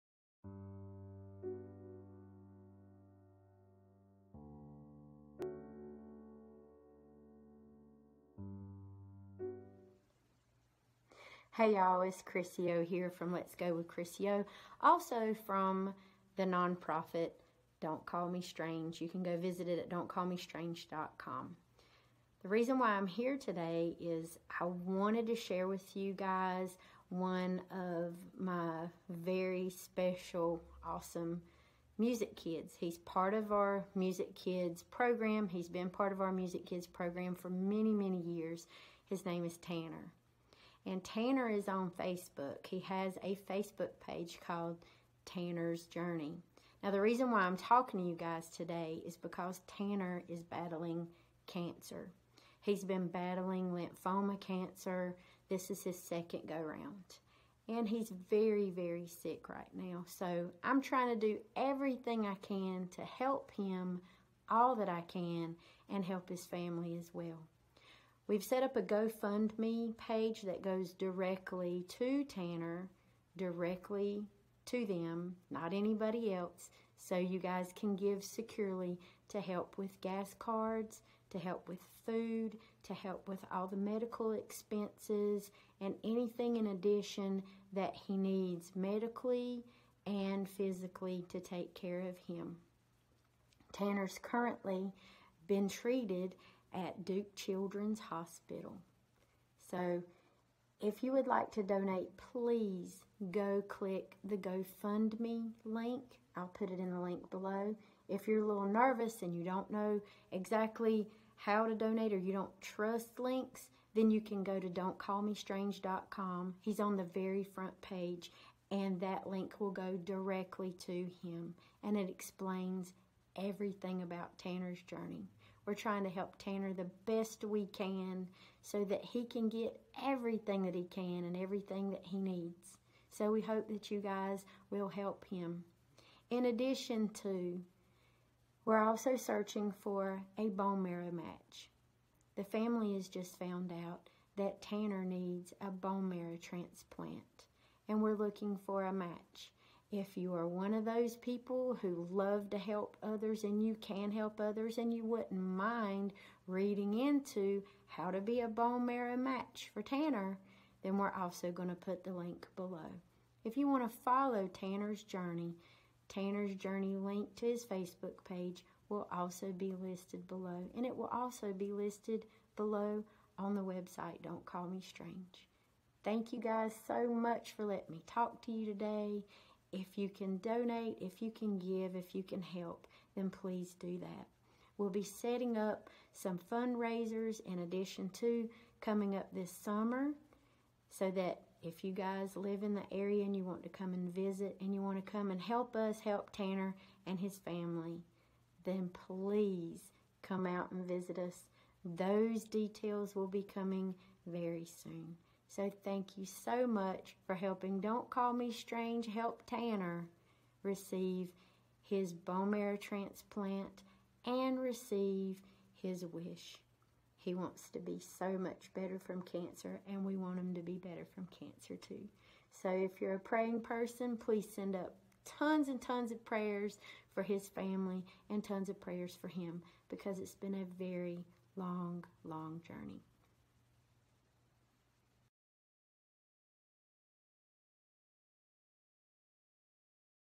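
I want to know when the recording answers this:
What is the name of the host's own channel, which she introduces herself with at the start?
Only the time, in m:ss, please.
0:13.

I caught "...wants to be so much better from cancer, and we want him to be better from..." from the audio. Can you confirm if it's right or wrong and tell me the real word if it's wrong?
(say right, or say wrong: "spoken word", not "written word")
right.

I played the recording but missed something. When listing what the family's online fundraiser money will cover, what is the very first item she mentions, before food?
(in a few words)
Gas cards.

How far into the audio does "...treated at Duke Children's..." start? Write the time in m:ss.
1:35.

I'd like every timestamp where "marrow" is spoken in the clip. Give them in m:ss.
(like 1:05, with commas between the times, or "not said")
2:20, 2:26, 2:38, 3:32.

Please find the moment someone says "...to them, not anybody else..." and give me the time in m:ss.
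1:14.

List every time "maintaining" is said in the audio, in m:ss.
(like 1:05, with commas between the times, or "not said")
not said.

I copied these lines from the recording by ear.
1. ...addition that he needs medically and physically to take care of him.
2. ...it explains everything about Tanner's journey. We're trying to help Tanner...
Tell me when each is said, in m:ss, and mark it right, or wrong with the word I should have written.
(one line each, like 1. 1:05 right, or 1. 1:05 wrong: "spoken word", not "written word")
1. 1:26 right
2. 2:01 right.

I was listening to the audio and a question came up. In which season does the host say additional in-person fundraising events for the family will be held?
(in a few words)
Summer.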